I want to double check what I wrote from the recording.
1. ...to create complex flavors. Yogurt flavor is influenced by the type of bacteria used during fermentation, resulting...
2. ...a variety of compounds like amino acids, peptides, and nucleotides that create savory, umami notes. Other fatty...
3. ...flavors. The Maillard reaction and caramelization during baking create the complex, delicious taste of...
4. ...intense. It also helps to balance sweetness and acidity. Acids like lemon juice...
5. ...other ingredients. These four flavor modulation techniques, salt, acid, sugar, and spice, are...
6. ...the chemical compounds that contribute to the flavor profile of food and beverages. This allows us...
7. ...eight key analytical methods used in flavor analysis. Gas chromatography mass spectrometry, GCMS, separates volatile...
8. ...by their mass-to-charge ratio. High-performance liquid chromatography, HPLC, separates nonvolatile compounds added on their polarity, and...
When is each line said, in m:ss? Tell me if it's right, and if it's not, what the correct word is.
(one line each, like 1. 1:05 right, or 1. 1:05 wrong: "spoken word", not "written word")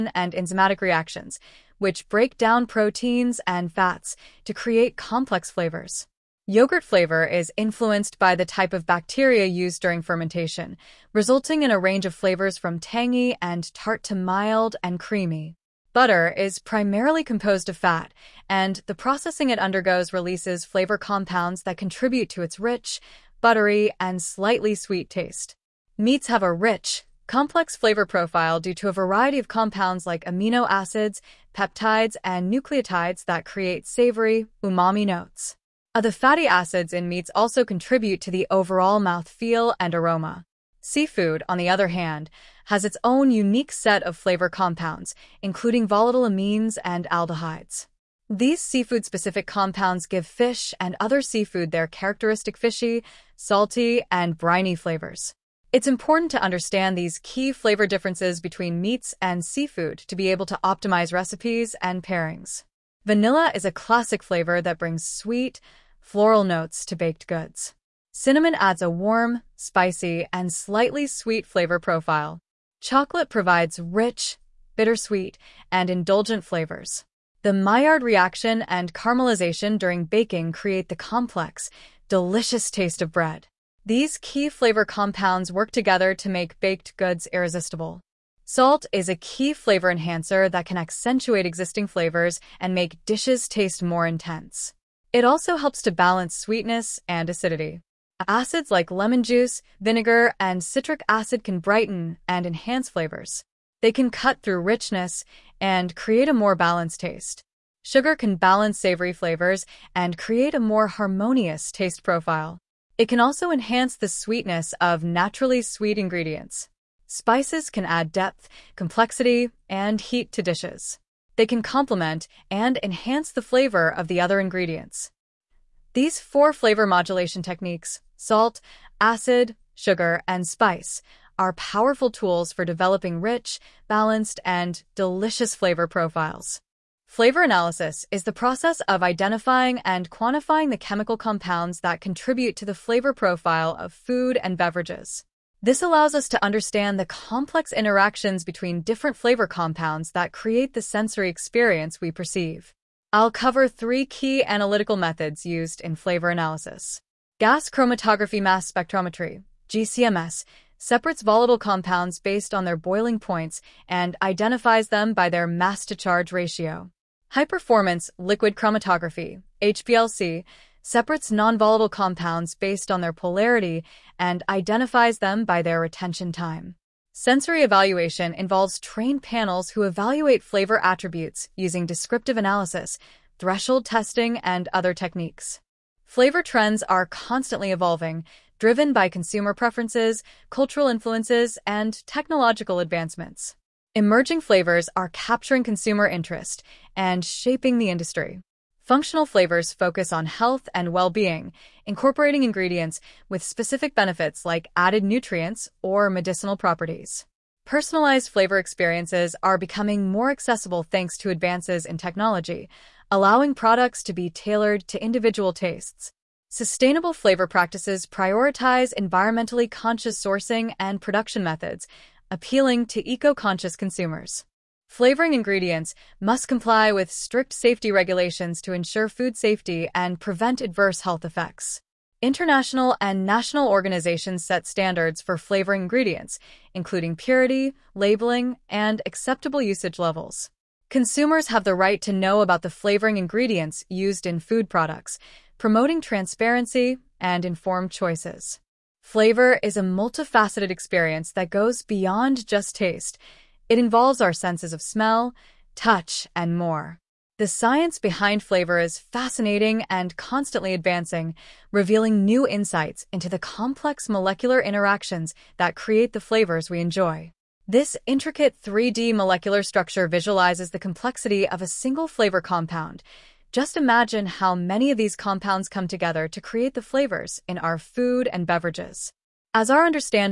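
1. 0:04 right
2. 0:28 right
3. 1:16 right
4. 1:34 right
5. 2:04 right
6. 2:20 right
7. 2:33 wrong: "three", not "eight"
8. 2:45 wrong: "based", not "added".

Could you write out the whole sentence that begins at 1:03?
Vanilla is a classic flavor that brings sweet, floral notes to baked goods.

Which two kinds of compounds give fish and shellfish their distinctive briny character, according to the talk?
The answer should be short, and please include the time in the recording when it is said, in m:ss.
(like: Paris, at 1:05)
volatile amines and aldehydes, at 0:45.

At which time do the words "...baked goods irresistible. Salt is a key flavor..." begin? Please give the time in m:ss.
1:26.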